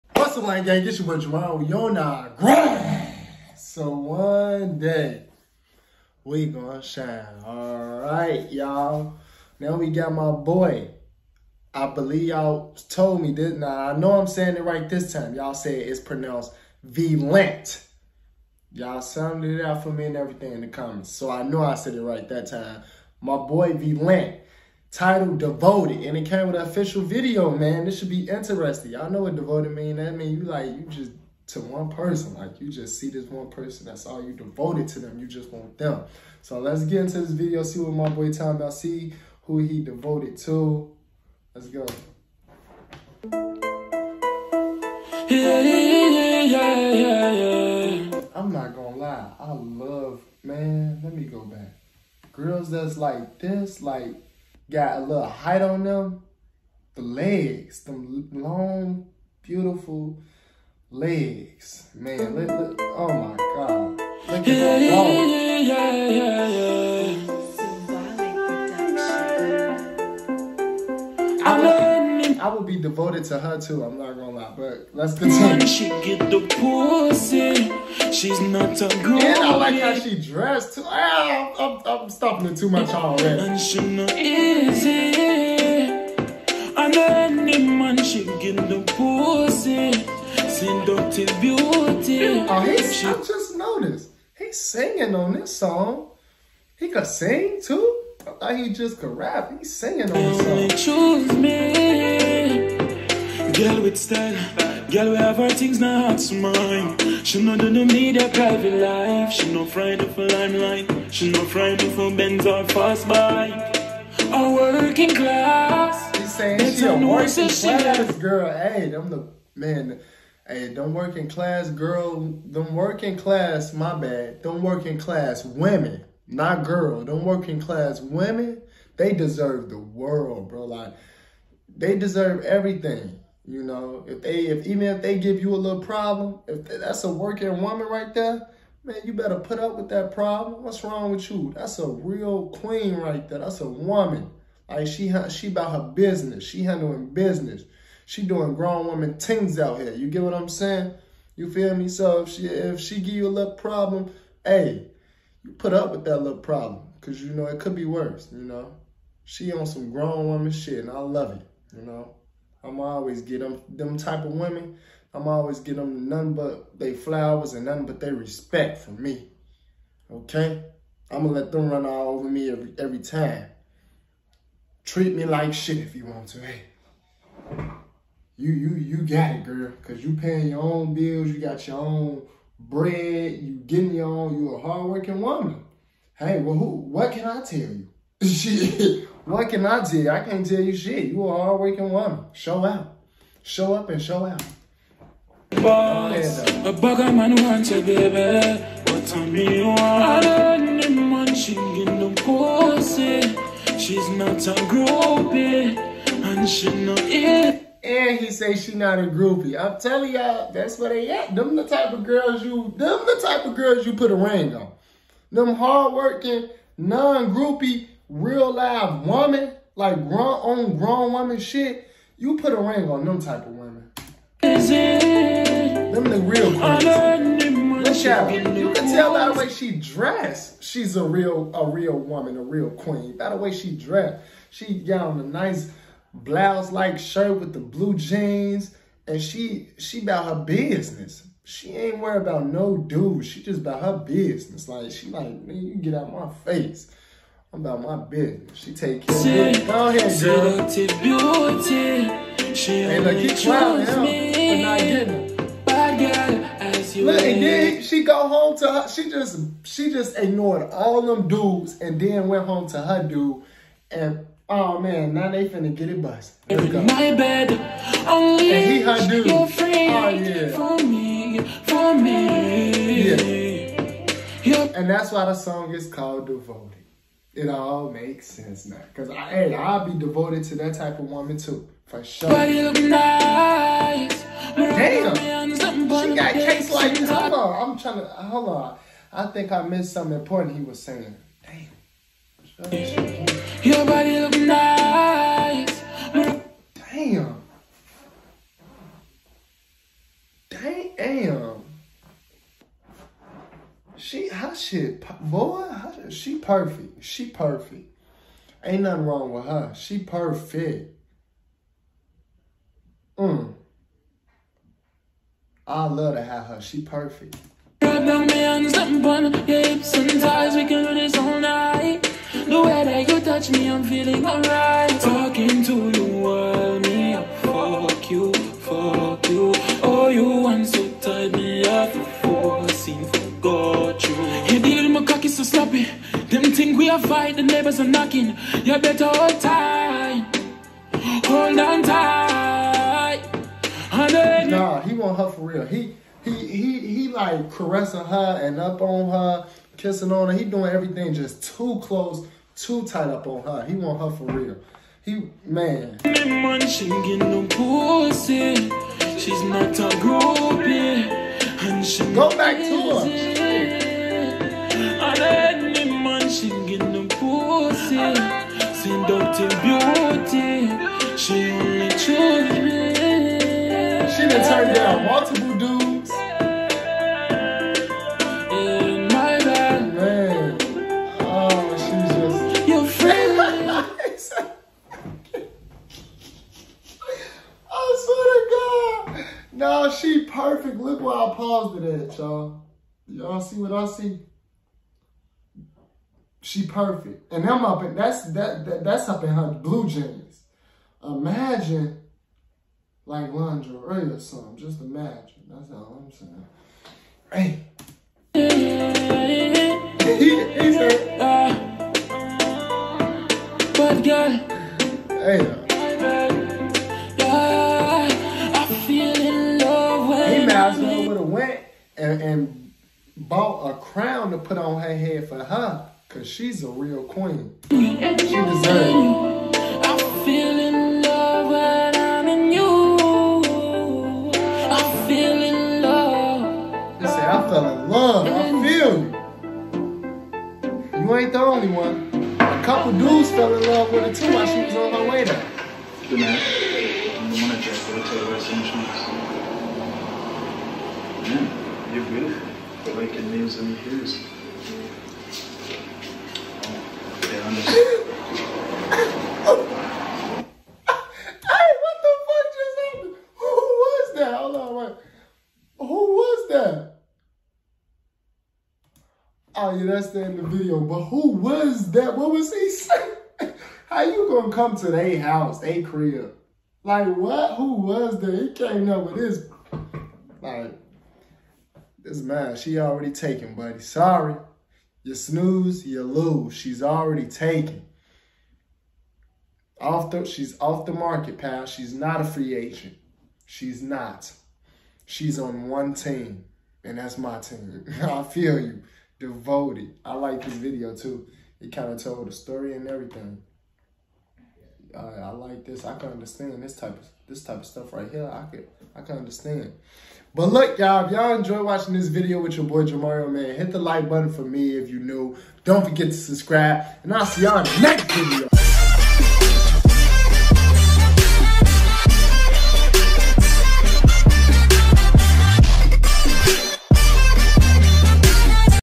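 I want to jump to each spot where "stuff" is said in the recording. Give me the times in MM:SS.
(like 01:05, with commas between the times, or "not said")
08:27.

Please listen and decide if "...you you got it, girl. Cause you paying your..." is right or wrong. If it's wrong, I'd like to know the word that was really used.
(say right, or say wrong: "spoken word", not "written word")
right.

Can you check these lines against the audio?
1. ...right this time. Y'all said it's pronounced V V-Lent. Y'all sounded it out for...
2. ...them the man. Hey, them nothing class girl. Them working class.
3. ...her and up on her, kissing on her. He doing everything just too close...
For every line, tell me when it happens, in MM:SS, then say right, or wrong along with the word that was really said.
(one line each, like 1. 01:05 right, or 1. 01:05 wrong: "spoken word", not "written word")
1. 00:14 right
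2. 01:58 wrong: "working", not "nothing"
3. 05:48 right.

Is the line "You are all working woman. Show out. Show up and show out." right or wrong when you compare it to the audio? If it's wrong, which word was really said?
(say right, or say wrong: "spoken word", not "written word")
right.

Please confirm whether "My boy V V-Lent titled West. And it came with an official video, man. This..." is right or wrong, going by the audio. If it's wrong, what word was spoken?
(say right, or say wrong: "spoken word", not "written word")
wrong: "Devoted", not "West".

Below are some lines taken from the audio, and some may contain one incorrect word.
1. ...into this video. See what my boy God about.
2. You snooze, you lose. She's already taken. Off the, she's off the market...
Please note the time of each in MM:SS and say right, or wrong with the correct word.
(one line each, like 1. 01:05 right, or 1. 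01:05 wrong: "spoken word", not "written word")
1. 00:37 wrong: "Tom", not "God"
2. 08:05 right.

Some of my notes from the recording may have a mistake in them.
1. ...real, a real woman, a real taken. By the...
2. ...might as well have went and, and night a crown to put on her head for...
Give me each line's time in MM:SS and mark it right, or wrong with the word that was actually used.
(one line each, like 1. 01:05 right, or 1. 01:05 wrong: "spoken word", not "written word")
1. 03:51 wrong: "queen", not "taken"
2. 07:00 wrong: "bought", not "night".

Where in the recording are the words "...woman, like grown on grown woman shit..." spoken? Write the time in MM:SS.
03:39.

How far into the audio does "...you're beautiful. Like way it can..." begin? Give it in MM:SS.
07:31.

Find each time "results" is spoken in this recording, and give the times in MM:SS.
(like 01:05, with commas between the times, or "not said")
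not said.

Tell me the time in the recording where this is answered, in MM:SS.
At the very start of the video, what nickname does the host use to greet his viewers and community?
00:00.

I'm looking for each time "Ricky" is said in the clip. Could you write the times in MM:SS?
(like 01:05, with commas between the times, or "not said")
not said.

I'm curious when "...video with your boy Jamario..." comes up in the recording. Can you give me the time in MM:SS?
08:32.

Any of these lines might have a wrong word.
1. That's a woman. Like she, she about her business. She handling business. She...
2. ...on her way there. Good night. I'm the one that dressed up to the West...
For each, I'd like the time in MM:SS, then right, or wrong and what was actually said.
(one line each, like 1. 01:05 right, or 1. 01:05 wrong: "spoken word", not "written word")
1. 02:23 right
2. 07:24 right.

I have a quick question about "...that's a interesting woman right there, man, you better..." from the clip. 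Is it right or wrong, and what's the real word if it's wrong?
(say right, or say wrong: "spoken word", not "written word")
wrong: "working", not "interesting".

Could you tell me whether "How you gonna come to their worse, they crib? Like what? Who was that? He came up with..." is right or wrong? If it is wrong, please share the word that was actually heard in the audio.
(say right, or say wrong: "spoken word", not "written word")
wrong: "house", not "worse".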